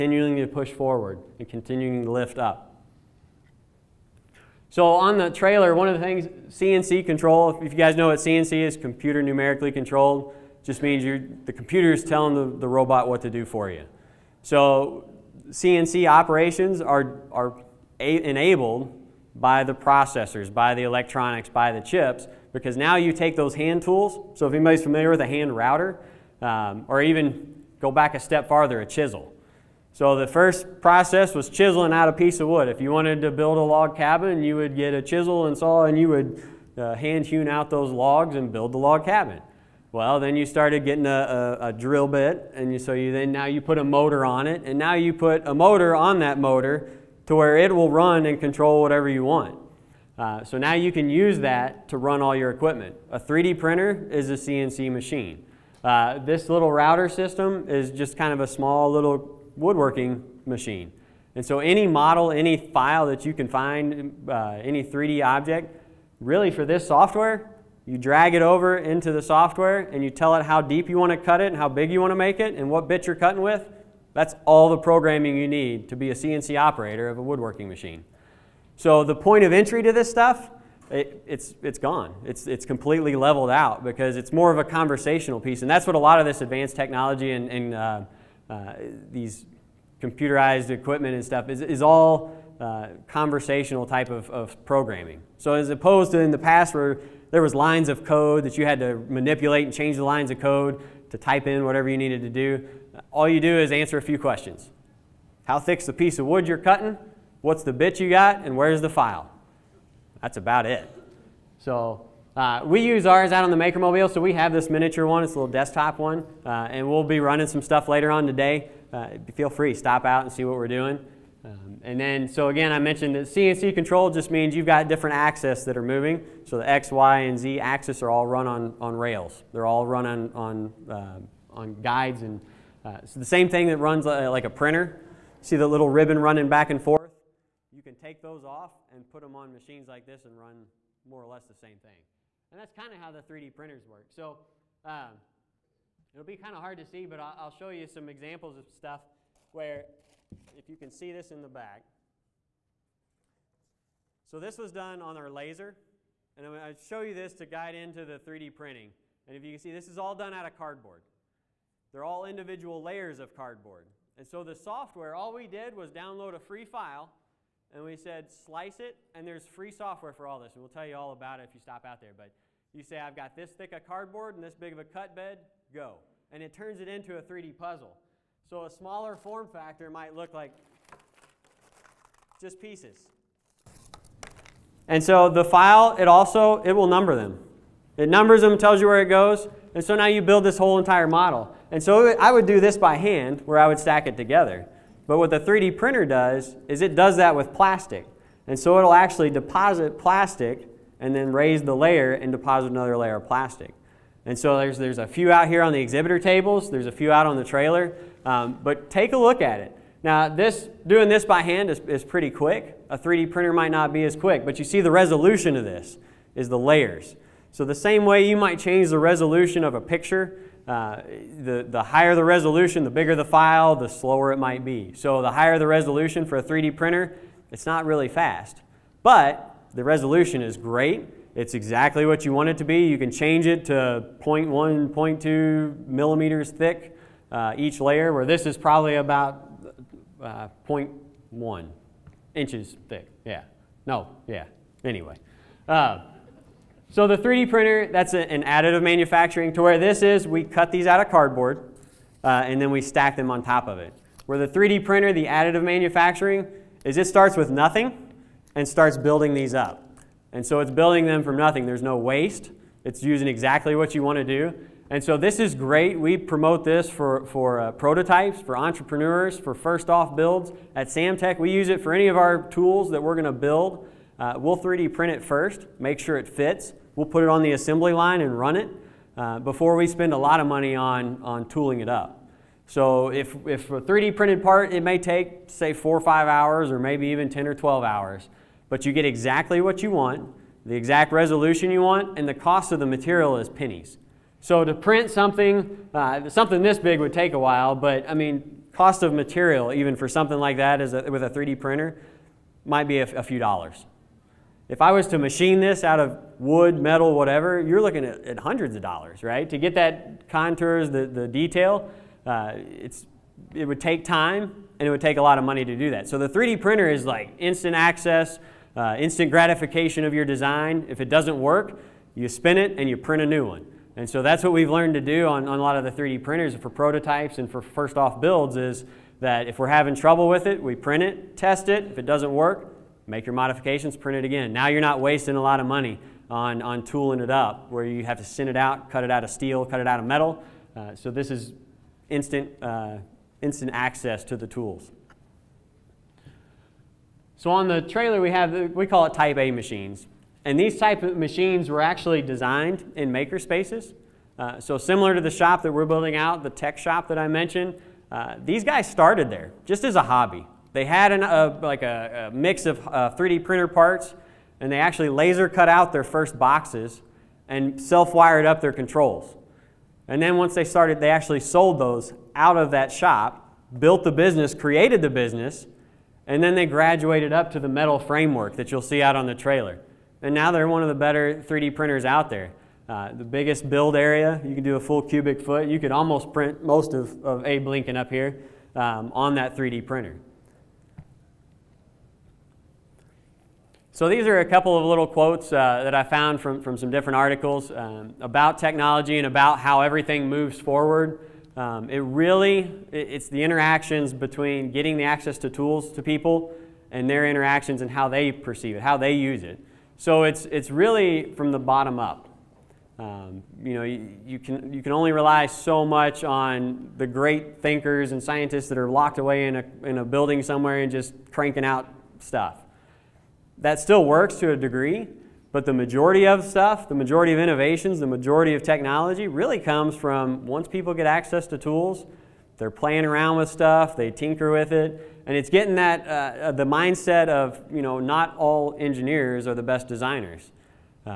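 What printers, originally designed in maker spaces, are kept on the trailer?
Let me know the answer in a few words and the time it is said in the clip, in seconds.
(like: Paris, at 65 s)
Type A machines, at 349 s.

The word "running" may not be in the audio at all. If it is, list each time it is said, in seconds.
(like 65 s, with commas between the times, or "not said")
117 s, 136 s.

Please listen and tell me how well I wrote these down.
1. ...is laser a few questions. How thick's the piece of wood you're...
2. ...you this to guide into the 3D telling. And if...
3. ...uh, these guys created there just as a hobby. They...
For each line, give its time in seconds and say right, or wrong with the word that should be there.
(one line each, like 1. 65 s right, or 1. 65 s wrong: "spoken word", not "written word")
1. 103 s wrong: "answer", not "laser"
2. 157 s wrong: "printing", not "telling"
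3. 358 s wrong: "started", not "created".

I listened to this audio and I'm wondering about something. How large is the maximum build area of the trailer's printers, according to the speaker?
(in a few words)
a full cubic foot.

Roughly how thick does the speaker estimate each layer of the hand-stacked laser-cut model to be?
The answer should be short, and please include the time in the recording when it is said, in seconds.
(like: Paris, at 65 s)
0.1 inches, at 240 s.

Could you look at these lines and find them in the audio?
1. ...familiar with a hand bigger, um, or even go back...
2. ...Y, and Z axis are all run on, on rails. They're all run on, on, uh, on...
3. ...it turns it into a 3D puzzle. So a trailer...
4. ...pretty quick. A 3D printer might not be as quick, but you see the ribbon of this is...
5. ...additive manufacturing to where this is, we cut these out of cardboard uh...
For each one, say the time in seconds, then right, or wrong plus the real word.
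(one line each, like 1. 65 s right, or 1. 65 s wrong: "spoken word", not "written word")
1. 24 s wrong: "router", not "bigger"
2. 126 s right
3. 176 s wrong: "smaller", not "trailer"
4. 212 s wrong: "resolution", not "ribbon"
5. 248 s right.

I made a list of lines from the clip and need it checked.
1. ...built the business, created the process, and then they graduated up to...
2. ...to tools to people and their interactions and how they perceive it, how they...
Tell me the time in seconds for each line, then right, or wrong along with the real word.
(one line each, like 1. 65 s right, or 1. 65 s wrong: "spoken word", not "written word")
1. 373 s wrong: "business", not "process"
2. 405 s right.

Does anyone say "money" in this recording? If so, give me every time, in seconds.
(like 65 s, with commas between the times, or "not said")
280 s, 315 s, 335 s.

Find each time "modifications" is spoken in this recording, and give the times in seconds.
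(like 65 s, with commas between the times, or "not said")
333 s.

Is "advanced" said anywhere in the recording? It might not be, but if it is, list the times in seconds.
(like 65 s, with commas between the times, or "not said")
86 s.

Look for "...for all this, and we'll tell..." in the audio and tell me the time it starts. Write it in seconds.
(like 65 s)
170 s.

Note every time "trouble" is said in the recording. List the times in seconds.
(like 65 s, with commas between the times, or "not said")
329 s.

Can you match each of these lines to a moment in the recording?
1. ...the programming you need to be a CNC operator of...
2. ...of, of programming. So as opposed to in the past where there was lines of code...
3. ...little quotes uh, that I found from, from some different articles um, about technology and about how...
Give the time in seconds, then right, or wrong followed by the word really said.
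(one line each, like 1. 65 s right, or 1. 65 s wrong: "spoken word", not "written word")
1. 74 s right
2. 94 s right
3. 394 s right.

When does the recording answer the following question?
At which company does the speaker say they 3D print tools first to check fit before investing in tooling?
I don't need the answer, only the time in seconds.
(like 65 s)
270 s.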